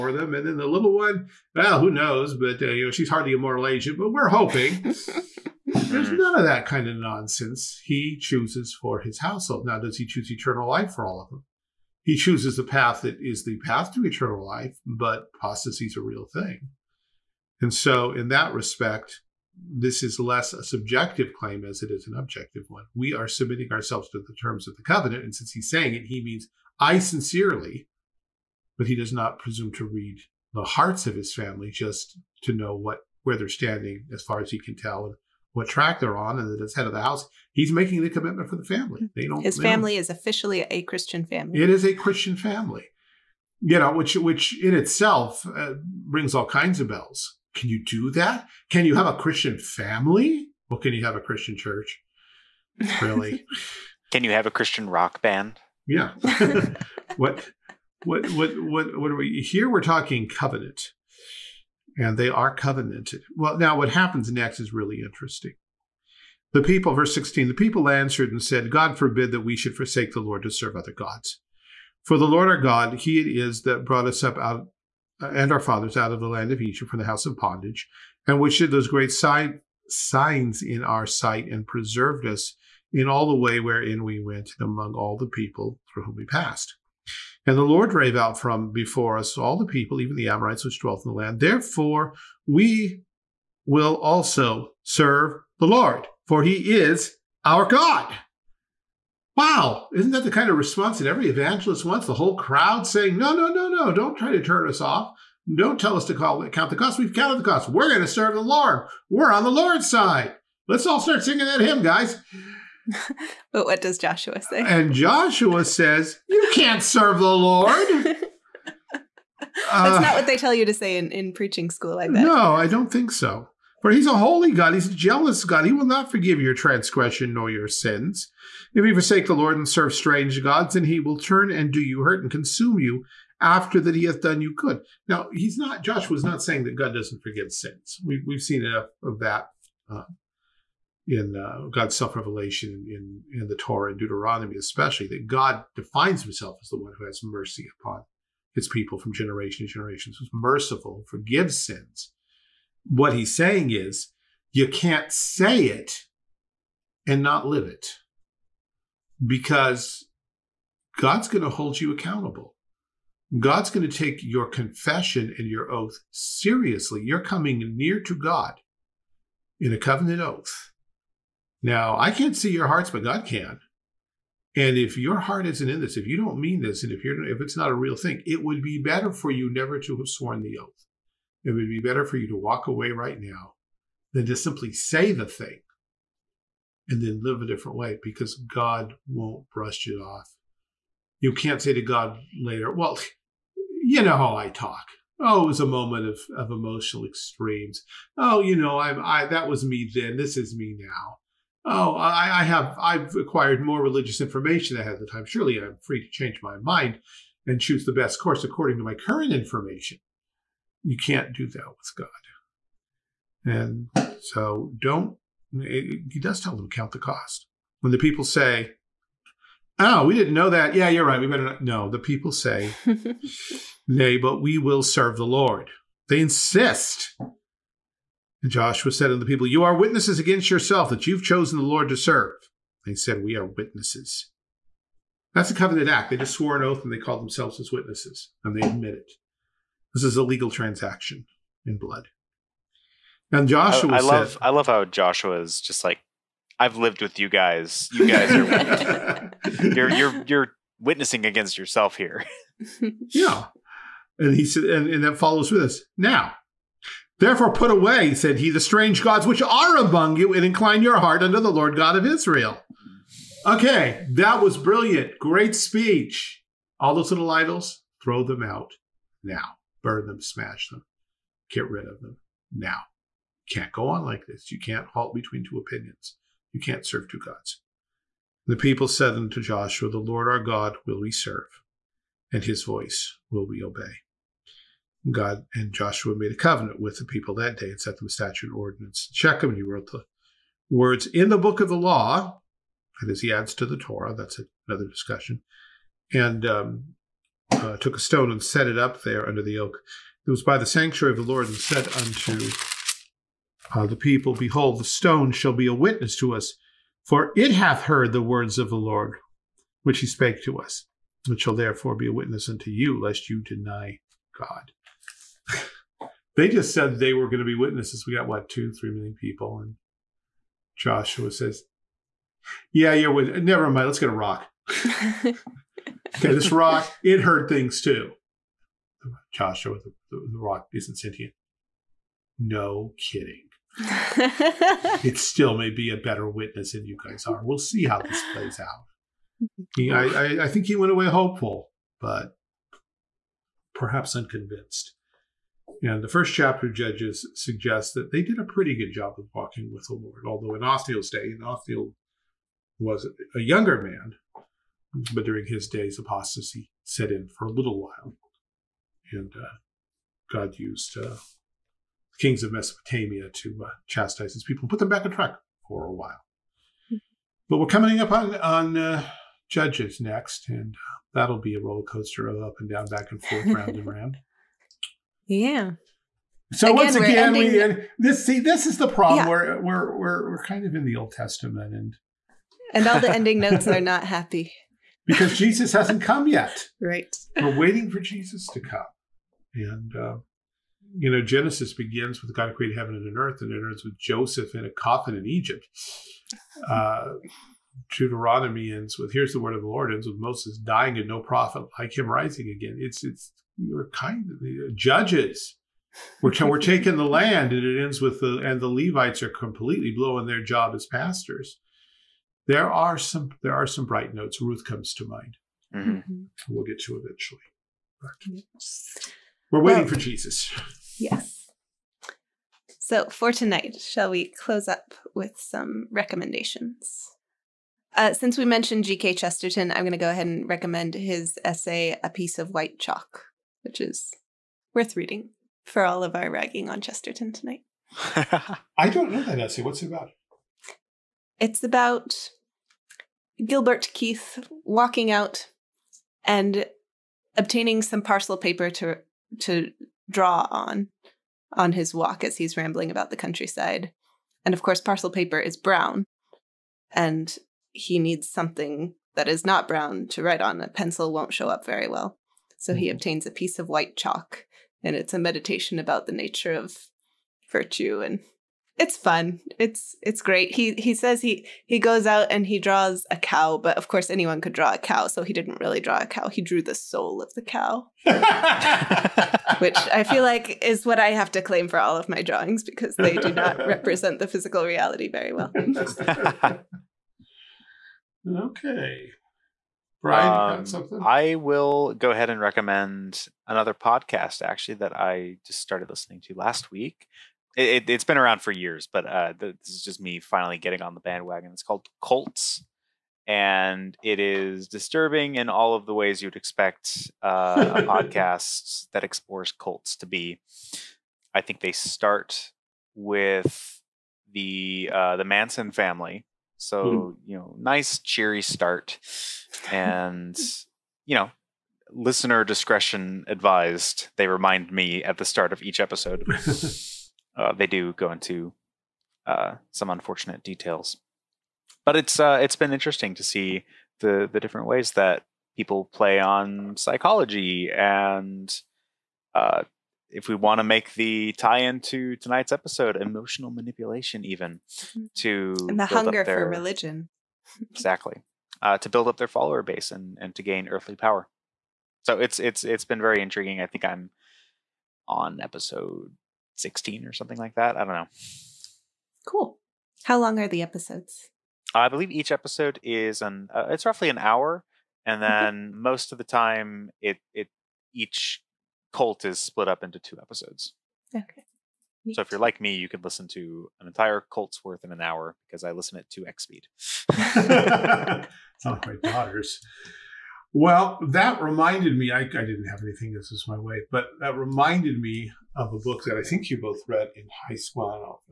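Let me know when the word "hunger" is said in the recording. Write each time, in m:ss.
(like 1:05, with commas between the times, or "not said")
9:05.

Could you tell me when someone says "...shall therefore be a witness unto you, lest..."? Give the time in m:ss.
5:11.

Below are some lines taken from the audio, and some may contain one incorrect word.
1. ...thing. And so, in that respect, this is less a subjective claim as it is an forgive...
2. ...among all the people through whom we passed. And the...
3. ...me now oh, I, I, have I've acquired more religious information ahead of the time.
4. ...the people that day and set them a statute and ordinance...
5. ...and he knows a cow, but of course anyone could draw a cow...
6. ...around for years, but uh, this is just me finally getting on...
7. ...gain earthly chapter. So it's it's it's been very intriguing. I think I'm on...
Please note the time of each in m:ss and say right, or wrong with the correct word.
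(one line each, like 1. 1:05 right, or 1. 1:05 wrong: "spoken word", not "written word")
1. 0:16 wrong: "objective", not "forgive"
2. 1:24 right
3. 3:20 right
4. 4:46 right
5. 7:52 wrong: "draws", not "knows"
6. 8:18 right
7. 9:10 wrong: "power", not "chapter".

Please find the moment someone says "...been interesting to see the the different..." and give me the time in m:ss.
8:52.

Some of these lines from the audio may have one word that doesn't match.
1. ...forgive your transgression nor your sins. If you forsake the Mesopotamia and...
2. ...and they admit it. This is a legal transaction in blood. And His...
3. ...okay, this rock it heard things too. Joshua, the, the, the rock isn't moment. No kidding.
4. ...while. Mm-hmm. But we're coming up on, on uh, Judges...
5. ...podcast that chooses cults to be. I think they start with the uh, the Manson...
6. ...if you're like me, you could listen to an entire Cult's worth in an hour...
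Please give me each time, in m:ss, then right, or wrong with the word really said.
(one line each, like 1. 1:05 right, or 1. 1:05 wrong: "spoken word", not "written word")
1. 2:06 wrong: "Lord", not "Mesopotamia"
2. 3:58 wrong: "Joshua", not "His"
3. 5:25 wrong: "sentient", not "moment"
4. 6:05 right
5. 8:27 wrong: "explores", not "chooses"
6. 9:32 right.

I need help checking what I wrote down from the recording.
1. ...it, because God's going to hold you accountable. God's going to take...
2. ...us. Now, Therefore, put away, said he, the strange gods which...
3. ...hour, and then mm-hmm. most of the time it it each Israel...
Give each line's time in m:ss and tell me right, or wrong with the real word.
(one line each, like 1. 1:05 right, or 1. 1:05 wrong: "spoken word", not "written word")
1. 2:37 right
2. 4:15 right
3. 9:24 wrong: "Cult", not "Israel".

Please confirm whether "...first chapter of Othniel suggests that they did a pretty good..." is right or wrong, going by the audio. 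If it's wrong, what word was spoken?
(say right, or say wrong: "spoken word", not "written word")
wrong: "Judges", not "Othniel".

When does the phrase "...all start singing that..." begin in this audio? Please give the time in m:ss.
1:50.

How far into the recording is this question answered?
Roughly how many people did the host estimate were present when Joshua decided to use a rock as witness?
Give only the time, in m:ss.
5:18.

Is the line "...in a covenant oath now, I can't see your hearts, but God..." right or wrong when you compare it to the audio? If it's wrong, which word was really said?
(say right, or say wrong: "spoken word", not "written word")
right.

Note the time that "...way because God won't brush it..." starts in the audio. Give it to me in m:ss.
3:07.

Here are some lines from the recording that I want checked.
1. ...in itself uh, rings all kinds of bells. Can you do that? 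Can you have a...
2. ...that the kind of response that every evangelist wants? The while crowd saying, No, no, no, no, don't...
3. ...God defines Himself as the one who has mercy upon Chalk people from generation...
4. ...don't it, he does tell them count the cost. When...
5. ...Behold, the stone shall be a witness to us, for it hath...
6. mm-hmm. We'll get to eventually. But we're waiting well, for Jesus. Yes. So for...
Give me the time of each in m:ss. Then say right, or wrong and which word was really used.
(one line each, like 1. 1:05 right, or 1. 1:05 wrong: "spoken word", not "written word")
1. 0:44 right
2. 1:40 wrong: "whole", not "while"
3. 2:25 wrong: "His", not "Chalk"
4. 3:34 right
5. 5:04 right
6. 6:55 right.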